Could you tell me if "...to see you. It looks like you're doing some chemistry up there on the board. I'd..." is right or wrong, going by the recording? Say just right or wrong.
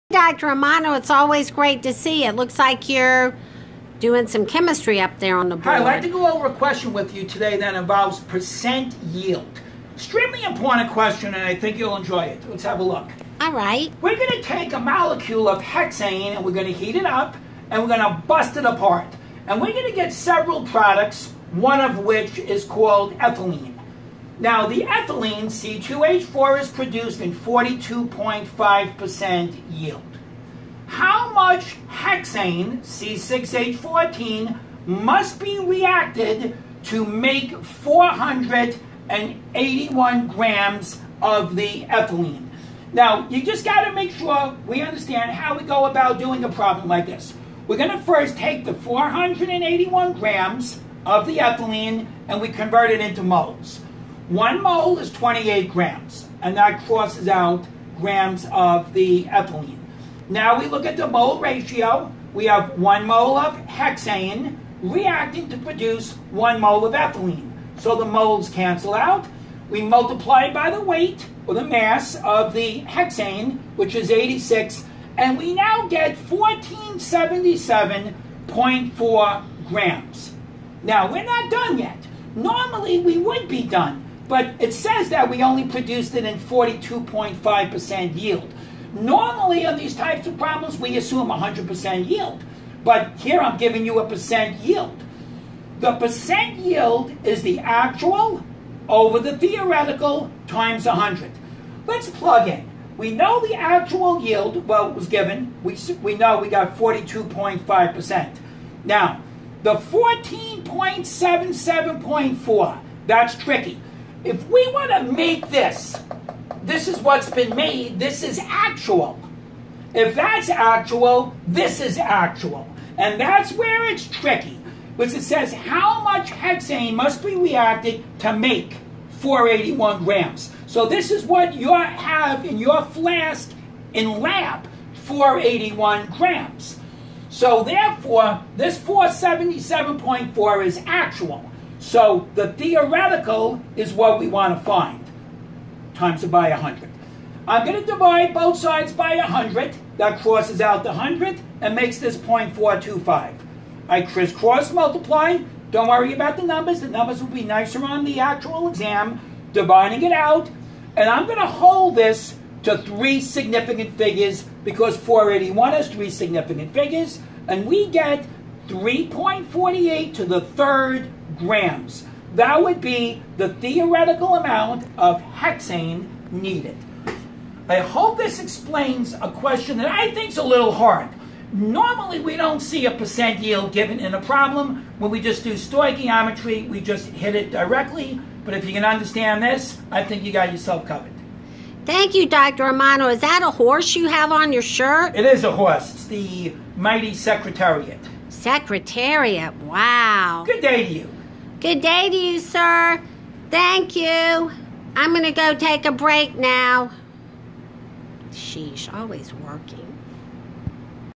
right.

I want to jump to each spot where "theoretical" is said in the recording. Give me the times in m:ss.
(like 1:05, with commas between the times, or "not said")
1:39, 2:22, 2:53.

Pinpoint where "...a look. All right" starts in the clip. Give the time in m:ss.
0:12.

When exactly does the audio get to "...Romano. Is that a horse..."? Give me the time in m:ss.
3:12.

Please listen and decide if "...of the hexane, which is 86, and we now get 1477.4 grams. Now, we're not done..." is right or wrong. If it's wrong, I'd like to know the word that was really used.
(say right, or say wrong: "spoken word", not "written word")
right.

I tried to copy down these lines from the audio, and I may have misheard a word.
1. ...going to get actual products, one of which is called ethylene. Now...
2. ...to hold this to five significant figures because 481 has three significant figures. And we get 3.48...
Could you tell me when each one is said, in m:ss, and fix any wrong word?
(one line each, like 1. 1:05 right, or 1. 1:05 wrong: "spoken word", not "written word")
1. 0:19 wrong: "several", not "actual"
2. 2:41 wrong: "three", not "five".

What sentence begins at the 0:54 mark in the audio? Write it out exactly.
One mole is 28 grams, and that crosses out grams of the ethylene.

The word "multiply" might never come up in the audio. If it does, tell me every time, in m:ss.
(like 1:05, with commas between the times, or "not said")
1:09, 2:34.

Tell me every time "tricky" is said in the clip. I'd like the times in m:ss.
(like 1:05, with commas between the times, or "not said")
1:53, 2:04.